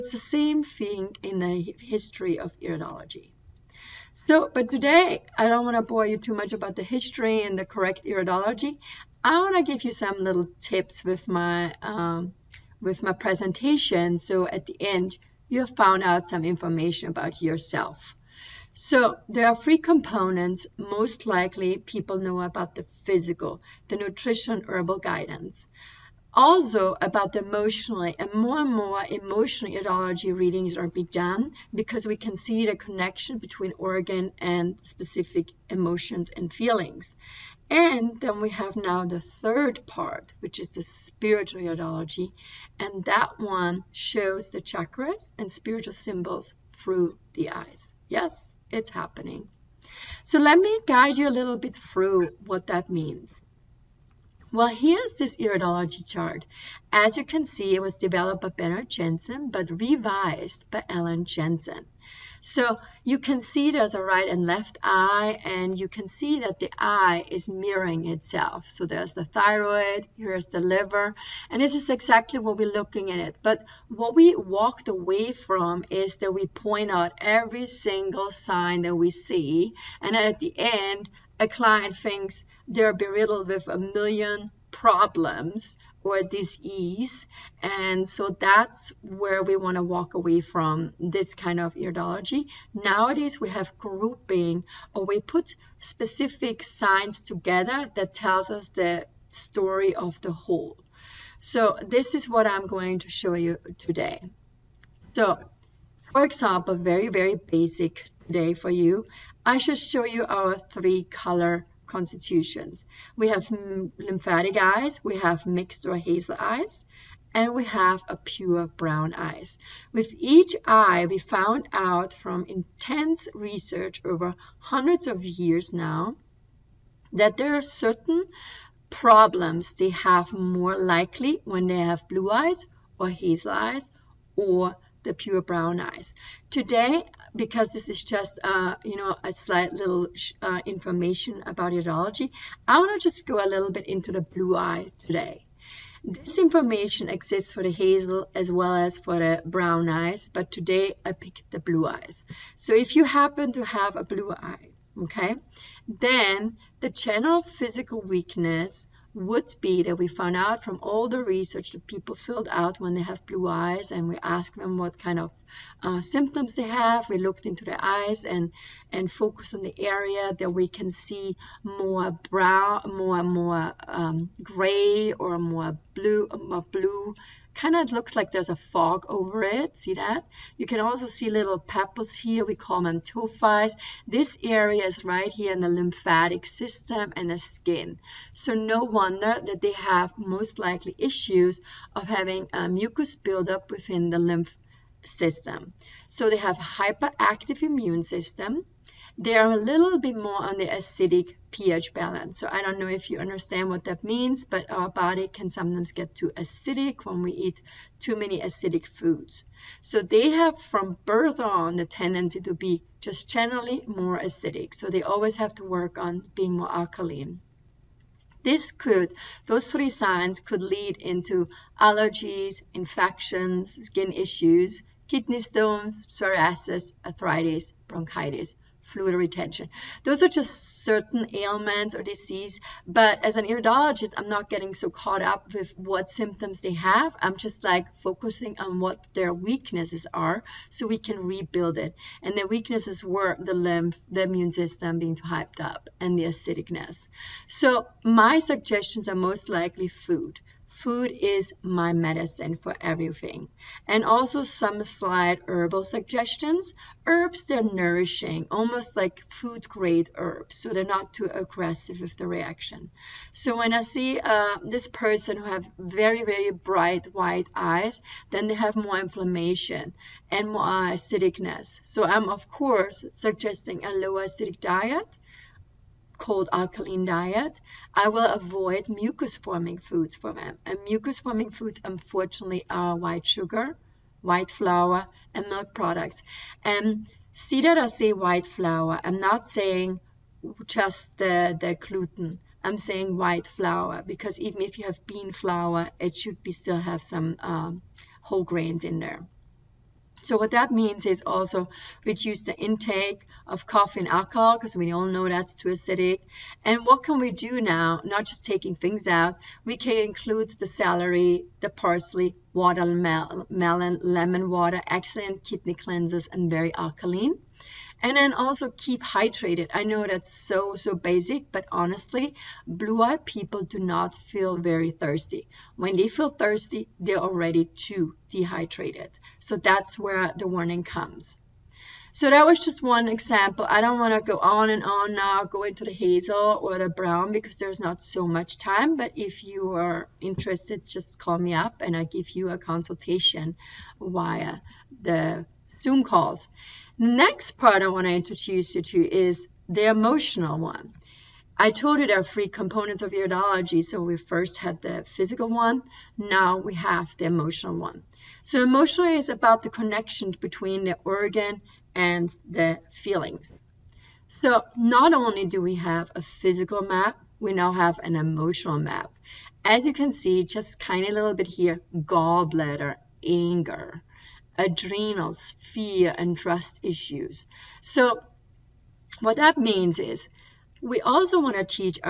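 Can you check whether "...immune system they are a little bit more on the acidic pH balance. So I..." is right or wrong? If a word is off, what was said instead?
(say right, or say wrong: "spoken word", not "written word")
right.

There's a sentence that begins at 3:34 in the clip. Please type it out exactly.
So they always have to work on being more alkaline.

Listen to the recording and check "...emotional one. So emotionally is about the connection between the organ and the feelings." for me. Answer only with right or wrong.
right.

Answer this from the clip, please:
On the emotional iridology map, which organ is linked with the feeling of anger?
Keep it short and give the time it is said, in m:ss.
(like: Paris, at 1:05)
gallbladder, at 6:11.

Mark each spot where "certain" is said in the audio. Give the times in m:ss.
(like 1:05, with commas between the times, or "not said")
2:07, 3:50.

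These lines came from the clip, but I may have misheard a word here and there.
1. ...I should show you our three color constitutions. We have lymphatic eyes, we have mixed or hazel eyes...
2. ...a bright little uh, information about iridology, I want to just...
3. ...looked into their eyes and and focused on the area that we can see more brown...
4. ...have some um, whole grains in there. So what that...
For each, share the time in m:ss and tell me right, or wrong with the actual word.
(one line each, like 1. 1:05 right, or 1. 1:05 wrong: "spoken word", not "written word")
1. 1:49 right
2. 2:19 wrong: "slight", not "bright"
3. 2:47 right
4. 4:56 right.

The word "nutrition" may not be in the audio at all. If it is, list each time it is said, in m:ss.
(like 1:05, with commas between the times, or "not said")
0:23.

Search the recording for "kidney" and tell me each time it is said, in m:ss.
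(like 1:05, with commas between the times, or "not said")
3:45, 5:15.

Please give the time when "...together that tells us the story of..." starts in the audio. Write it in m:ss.
1:37.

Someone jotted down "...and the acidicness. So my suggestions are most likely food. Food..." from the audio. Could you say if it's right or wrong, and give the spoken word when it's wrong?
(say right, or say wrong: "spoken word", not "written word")
right.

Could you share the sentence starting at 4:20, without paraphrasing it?
So they're not too aggressive with the reaction.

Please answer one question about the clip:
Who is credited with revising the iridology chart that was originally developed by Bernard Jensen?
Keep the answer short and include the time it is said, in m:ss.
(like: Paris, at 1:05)
Ellen Jensen, at 1:00.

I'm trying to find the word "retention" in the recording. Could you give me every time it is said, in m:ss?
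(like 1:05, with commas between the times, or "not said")
3:49.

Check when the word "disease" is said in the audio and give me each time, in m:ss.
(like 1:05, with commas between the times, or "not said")
1:26, 3:52.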